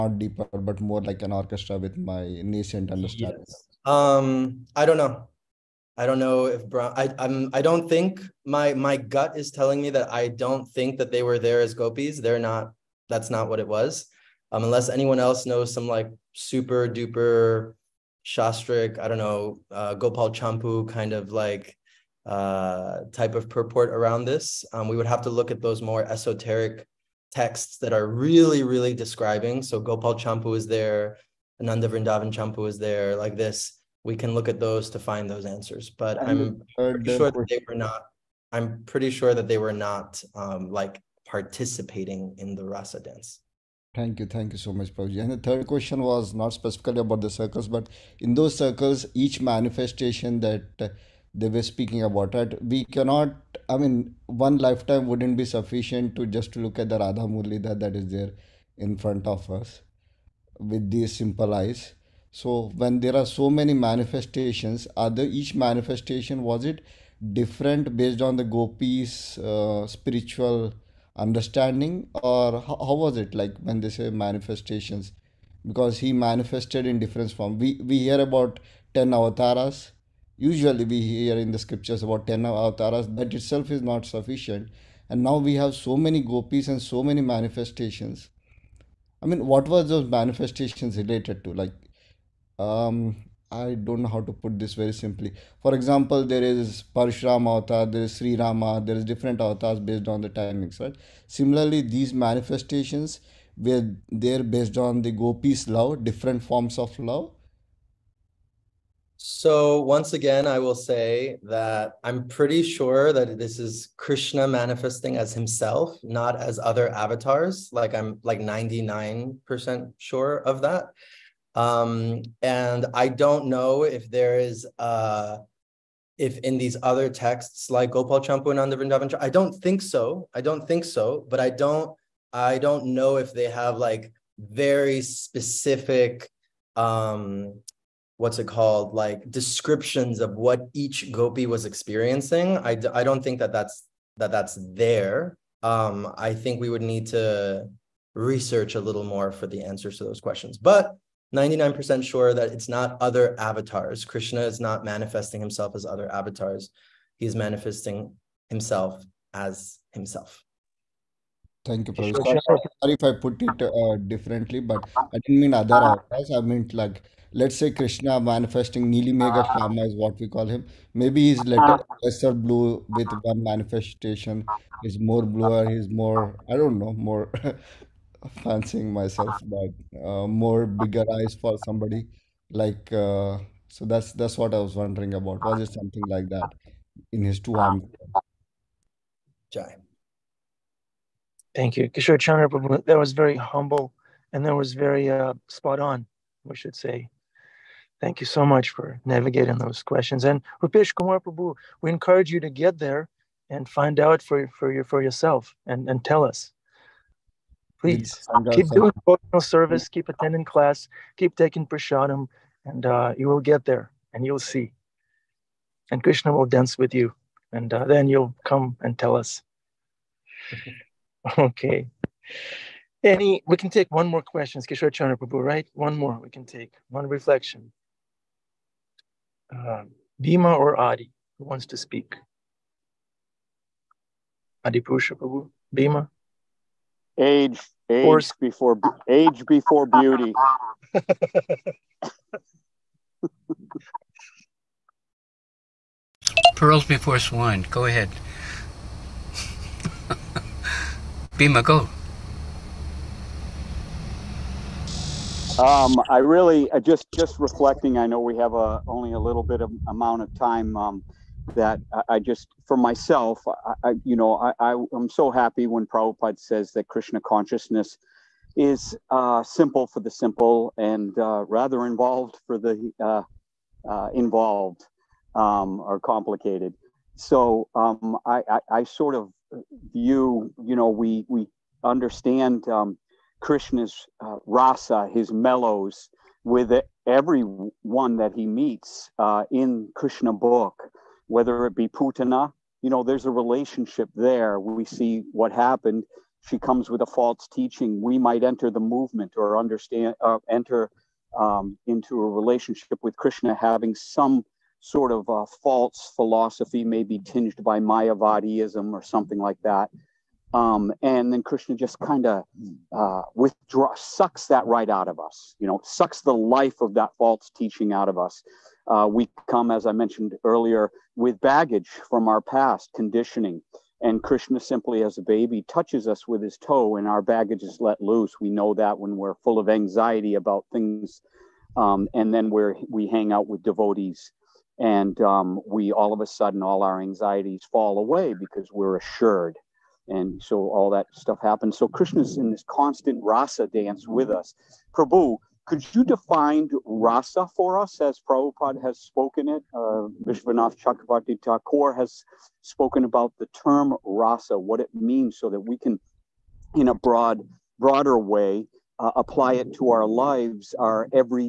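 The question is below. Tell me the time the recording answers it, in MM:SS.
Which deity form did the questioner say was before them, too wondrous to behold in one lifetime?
00:56.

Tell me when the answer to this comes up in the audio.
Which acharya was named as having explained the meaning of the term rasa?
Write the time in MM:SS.
05:50.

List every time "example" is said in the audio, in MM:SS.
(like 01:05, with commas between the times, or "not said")
01:35.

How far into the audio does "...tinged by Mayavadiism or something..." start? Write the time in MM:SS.
05:07.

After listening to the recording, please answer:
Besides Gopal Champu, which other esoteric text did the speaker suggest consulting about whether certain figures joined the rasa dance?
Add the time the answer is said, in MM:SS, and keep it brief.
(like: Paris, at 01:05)
Ananda Vrindavan Champu, at 00:31.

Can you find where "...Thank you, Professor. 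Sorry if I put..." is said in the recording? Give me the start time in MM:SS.
02:41.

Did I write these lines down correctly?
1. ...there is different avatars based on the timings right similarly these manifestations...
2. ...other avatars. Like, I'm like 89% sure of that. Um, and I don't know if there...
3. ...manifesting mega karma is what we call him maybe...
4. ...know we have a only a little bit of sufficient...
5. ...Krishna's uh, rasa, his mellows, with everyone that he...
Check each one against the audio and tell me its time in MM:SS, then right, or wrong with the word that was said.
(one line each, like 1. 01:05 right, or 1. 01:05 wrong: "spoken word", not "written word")
1. 01:38 right
2. 01:56 wrong: "99", not "89"
3. 02:48 right
4. 04:18 wrong: "amount", not "sufficient"
5. 04:43 right.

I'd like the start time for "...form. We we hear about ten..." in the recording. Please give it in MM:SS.
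01:17.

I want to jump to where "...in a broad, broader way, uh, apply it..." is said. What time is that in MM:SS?
05:56.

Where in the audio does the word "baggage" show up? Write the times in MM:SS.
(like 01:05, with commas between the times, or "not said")
05:21, 05:27.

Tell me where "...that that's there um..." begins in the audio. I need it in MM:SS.
02:24.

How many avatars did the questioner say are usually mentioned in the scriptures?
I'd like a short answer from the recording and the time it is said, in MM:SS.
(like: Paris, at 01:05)
10, at 01:22.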